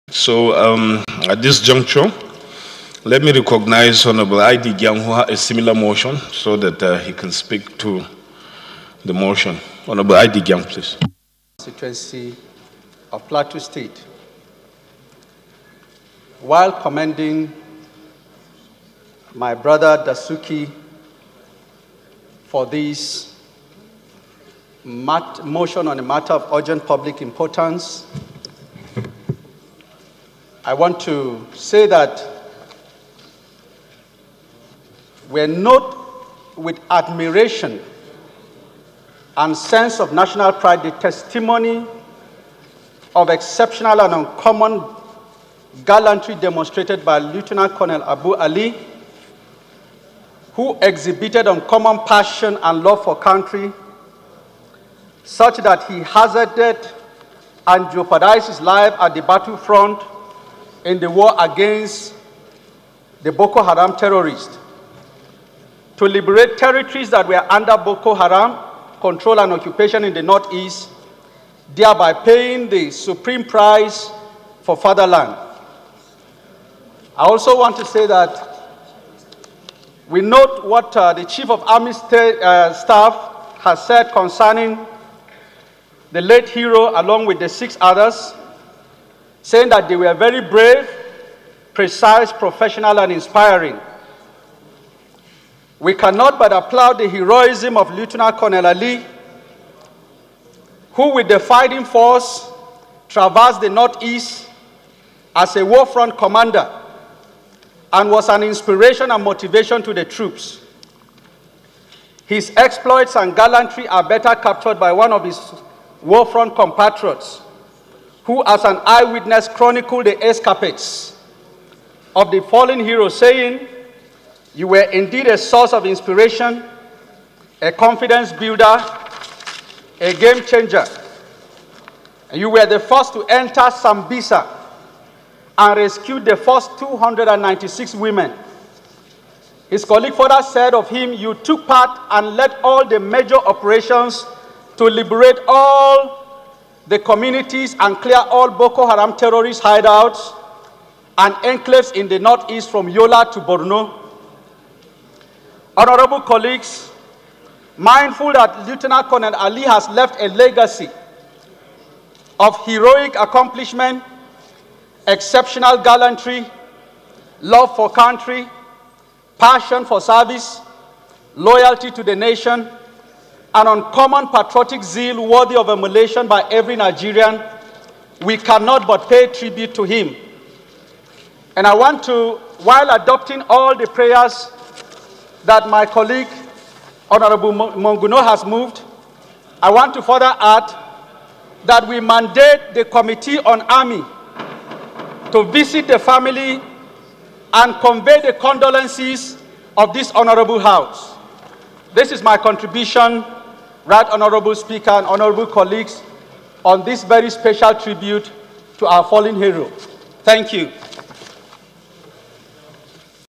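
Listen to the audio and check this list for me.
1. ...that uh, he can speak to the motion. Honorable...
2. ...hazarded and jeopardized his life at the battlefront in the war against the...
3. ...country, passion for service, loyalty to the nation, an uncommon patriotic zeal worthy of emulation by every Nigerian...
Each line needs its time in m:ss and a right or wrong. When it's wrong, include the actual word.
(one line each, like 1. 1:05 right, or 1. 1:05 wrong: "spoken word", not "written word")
1. 0:06 right
2. 0:55 right
3. 2:47 right.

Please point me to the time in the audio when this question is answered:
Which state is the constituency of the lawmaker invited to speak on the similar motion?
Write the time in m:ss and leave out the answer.
0:13.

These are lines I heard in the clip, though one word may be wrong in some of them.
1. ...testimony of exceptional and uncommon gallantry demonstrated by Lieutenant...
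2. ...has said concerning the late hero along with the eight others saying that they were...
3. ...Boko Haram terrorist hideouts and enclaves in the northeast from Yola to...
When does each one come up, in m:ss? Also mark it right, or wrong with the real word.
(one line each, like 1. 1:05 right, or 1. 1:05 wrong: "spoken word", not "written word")
1. 0:40 right
2. 1:23 wrong: "six", not "eight"
3. 2:28 right.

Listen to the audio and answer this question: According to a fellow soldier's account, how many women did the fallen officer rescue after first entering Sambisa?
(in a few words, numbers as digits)
296.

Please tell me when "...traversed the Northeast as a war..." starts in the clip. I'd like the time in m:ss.
1:43.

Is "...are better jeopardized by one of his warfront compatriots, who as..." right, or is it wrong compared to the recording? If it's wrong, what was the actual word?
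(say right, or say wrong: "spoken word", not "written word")
wrong: "captured", not "jeopardized".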